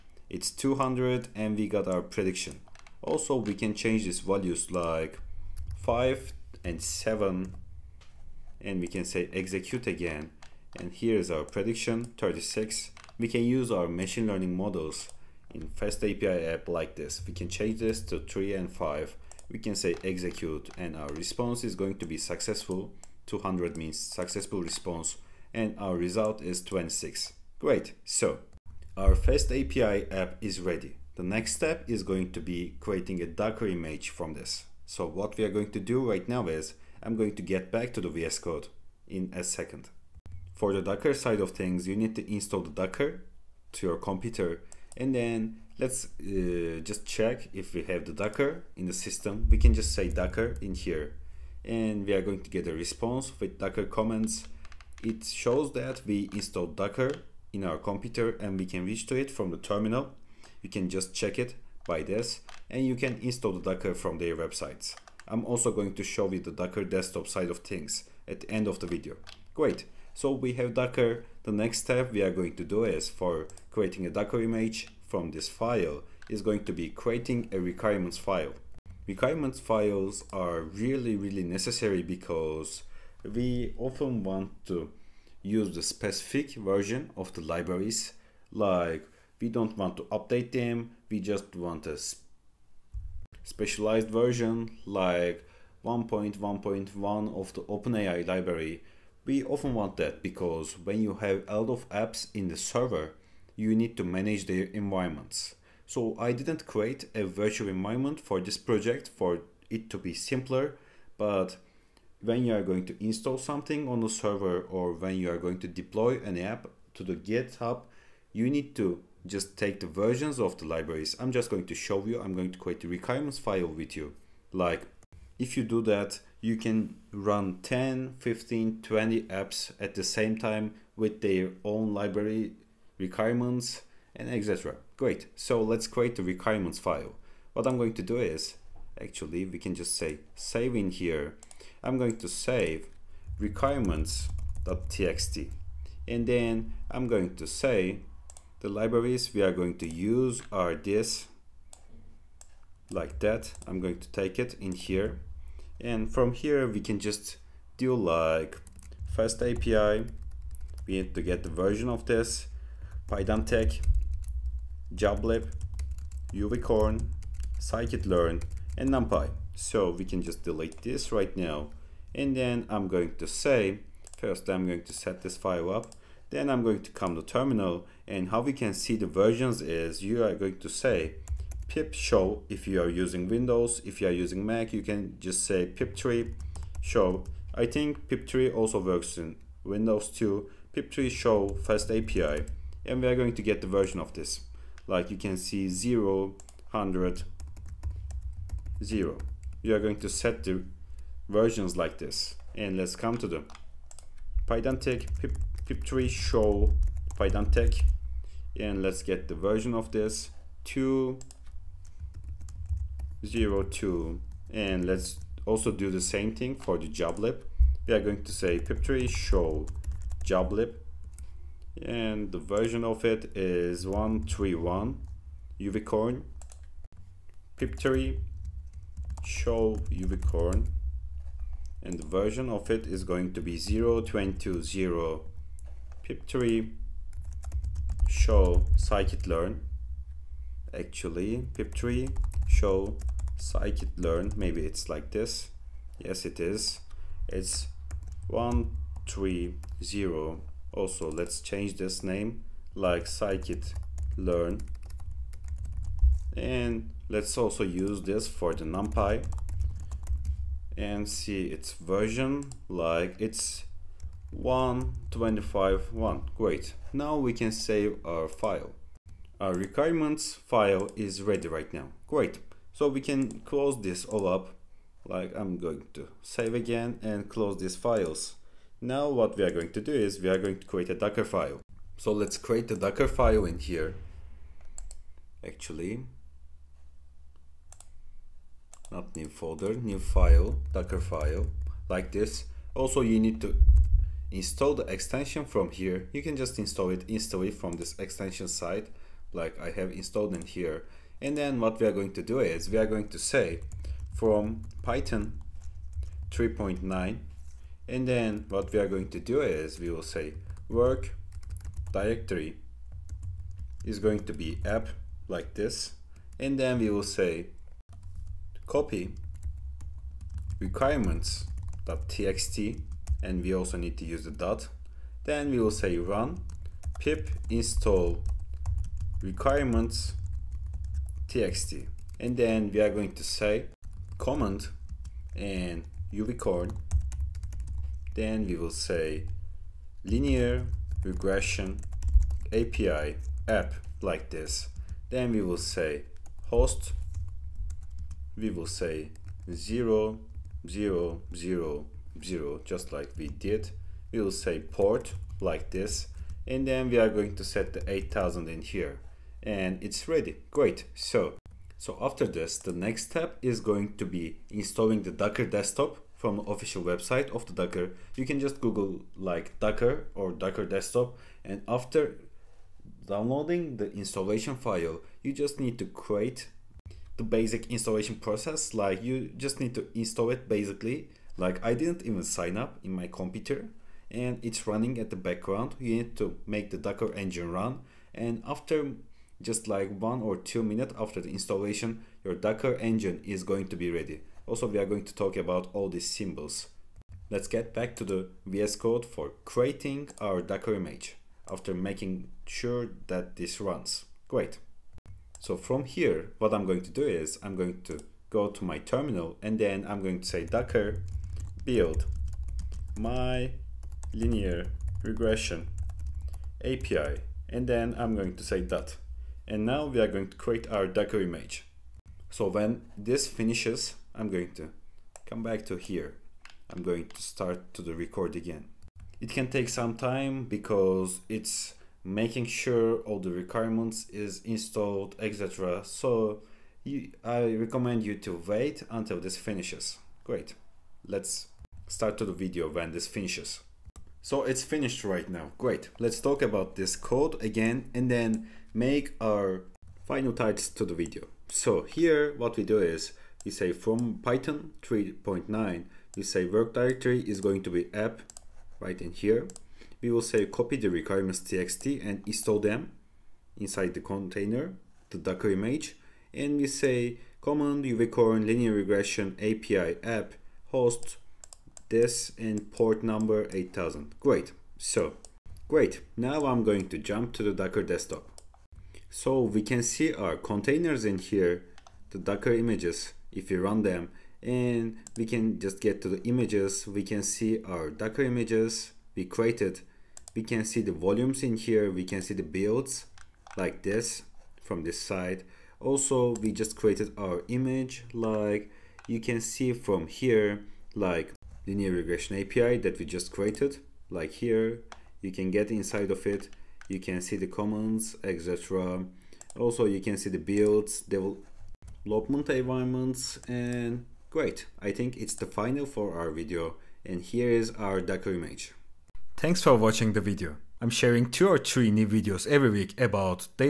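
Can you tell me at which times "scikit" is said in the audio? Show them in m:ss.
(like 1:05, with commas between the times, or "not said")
2:47, 3:58, 4:03, 4:13.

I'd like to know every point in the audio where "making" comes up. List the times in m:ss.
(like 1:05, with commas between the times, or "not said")
6:41, 7:12.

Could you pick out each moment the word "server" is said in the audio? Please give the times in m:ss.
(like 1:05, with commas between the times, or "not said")
1:42, 1:54.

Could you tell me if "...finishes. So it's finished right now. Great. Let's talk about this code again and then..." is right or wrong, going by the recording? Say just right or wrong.
right.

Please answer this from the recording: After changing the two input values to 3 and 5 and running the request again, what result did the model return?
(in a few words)
26.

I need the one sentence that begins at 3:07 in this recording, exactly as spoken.
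I think pip3 also works in Windows too.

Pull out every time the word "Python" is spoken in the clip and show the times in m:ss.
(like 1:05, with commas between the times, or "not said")
5:04, 7:34.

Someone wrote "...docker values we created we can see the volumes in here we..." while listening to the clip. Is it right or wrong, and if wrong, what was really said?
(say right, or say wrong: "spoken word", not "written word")
wrong: "images", not "values".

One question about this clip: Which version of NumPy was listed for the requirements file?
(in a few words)
1.25.1.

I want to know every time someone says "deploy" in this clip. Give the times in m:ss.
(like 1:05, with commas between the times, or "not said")
1:55.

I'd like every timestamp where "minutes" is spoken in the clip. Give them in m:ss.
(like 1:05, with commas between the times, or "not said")
6:30.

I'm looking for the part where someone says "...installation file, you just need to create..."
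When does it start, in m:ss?
6:13.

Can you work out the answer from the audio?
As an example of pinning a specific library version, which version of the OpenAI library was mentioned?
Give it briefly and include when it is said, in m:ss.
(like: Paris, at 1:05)
1.1.1, at 1:35.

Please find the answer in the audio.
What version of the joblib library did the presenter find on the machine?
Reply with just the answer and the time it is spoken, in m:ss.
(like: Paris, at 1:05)
1.3.1, at 3:43.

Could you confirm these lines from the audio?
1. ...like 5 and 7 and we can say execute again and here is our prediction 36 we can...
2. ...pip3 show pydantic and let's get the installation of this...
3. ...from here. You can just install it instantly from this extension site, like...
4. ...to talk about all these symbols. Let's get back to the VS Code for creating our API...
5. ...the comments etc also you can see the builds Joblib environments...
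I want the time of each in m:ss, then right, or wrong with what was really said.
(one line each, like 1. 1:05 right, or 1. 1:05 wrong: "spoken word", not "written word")
1. 0:04 right
2. 3:25 wrong: "version", not "installation"
3. 4:55 right
4. 6:35 wrong: "Docker", not "API"
5. 8:27 wrong: "Development", not "Joblib".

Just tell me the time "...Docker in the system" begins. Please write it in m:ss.
0:48.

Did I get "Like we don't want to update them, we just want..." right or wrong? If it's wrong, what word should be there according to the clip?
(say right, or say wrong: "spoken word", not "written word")
right.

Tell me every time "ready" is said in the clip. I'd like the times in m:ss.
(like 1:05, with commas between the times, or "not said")
0:30, 4:31, 6:00, 6:33.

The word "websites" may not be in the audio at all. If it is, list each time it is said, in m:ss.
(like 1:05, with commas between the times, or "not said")
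1:04, 6:06.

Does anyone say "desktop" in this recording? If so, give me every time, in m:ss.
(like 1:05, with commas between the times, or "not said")
1:06, 6:05, 6:10, 7:57.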